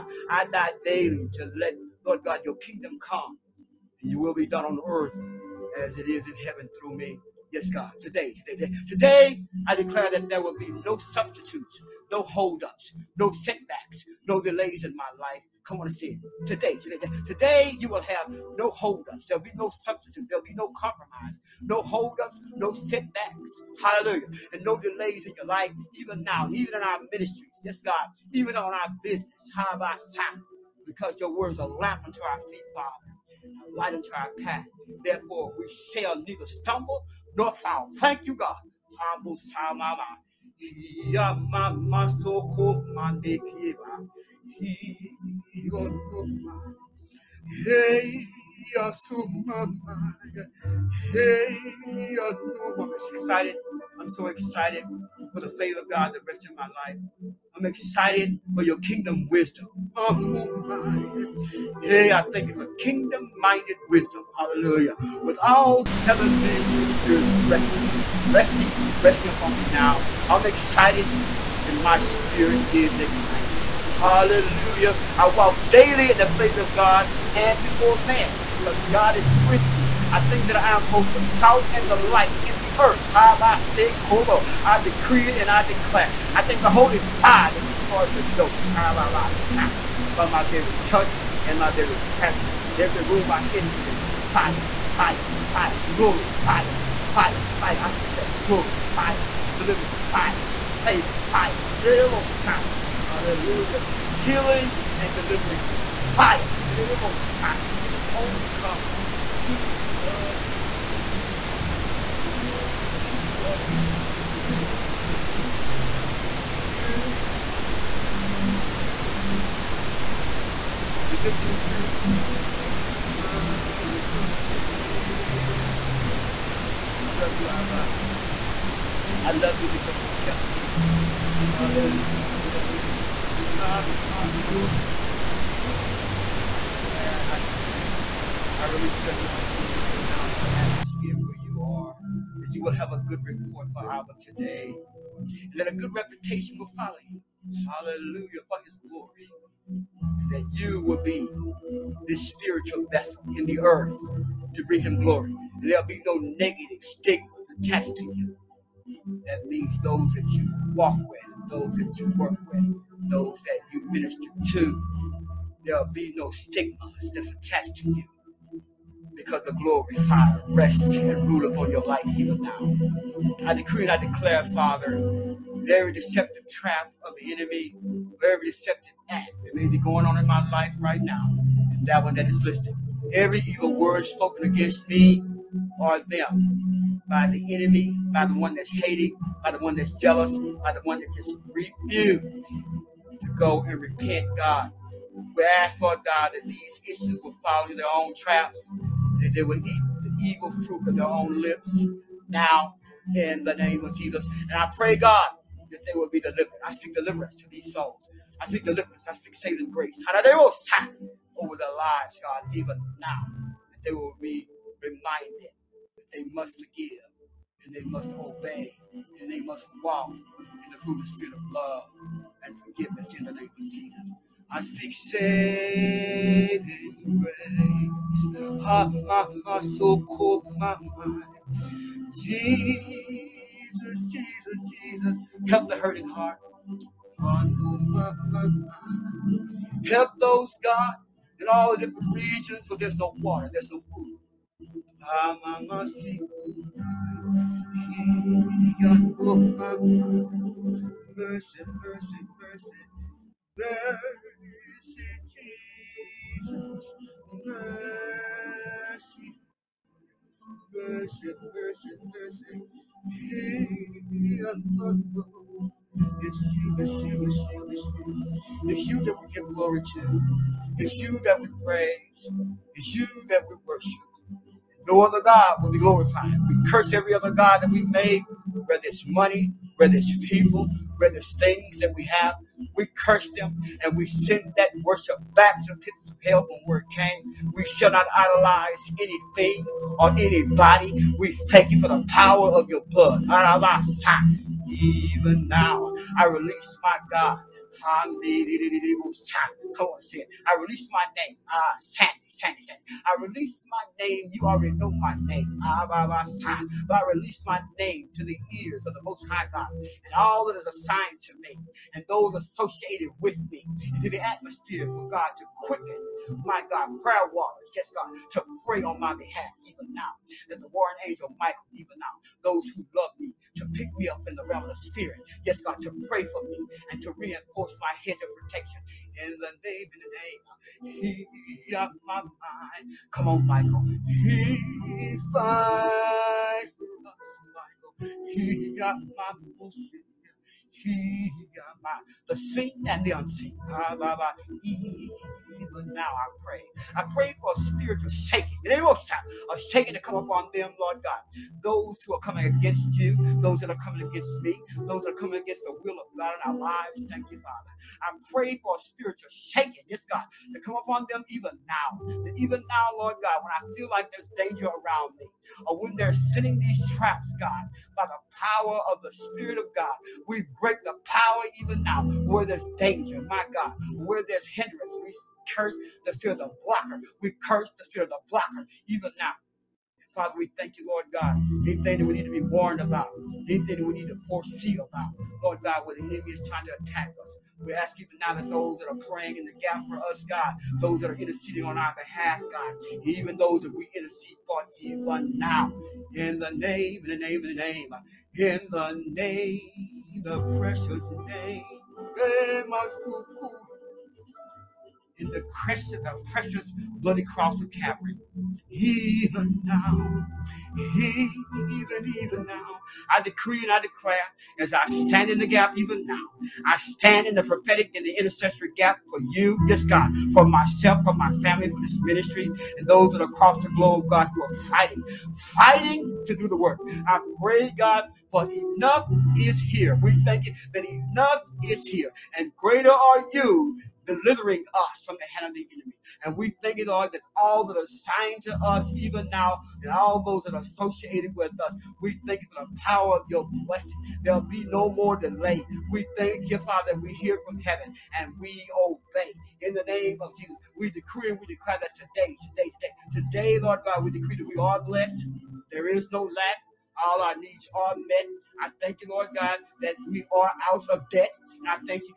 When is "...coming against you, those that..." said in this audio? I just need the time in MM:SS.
05:52.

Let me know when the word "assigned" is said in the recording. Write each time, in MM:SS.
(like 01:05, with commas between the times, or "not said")
05:10, 07:17.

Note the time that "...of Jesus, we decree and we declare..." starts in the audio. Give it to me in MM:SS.
07:30.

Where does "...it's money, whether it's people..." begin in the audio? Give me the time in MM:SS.
04:38.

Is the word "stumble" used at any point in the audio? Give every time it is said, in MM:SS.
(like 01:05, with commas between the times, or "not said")
00:36.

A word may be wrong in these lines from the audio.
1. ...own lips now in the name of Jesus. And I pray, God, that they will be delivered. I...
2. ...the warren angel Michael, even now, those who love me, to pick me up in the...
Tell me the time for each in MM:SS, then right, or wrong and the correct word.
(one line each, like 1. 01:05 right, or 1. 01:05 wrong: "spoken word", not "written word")
1. 03:21 right
2. 05:20 right.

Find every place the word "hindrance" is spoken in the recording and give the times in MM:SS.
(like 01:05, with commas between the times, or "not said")
06:14.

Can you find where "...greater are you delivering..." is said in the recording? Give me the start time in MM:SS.
07:12.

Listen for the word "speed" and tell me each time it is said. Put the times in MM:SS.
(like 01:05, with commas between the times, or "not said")
not said.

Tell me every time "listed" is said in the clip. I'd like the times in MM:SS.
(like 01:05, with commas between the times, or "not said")
03:02.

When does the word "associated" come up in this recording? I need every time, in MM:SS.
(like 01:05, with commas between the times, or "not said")
05:12, 07:20.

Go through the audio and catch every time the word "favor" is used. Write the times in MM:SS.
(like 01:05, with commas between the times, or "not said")
00:55, 01:16, 01:40.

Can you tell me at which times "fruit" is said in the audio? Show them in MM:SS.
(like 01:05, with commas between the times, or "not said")
03:20, 03:40.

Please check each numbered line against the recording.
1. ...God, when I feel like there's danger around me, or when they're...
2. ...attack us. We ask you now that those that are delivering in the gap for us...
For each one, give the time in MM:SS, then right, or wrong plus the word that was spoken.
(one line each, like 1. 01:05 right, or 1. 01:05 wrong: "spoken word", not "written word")
1. 06:03 right
2. 06:26 wrong: "praying", not "delivering".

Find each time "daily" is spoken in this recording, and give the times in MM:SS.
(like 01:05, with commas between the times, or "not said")
00:00, 01:15.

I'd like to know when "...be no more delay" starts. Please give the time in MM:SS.
07:24.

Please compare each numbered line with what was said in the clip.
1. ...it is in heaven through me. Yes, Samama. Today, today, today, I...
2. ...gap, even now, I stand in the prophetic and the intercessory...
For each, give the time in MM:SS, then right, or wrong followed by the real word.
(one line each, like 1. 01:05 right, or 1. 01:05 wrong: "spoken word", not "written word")
1. 00:05 wrong: "God", not "Samama"
2. 06:55 right.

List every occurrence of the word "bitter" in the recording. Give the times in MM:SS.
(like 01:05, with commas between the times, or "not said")
not said.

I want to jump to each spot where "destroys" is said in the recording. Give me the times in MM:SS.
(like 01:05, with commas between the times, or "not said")
01:27.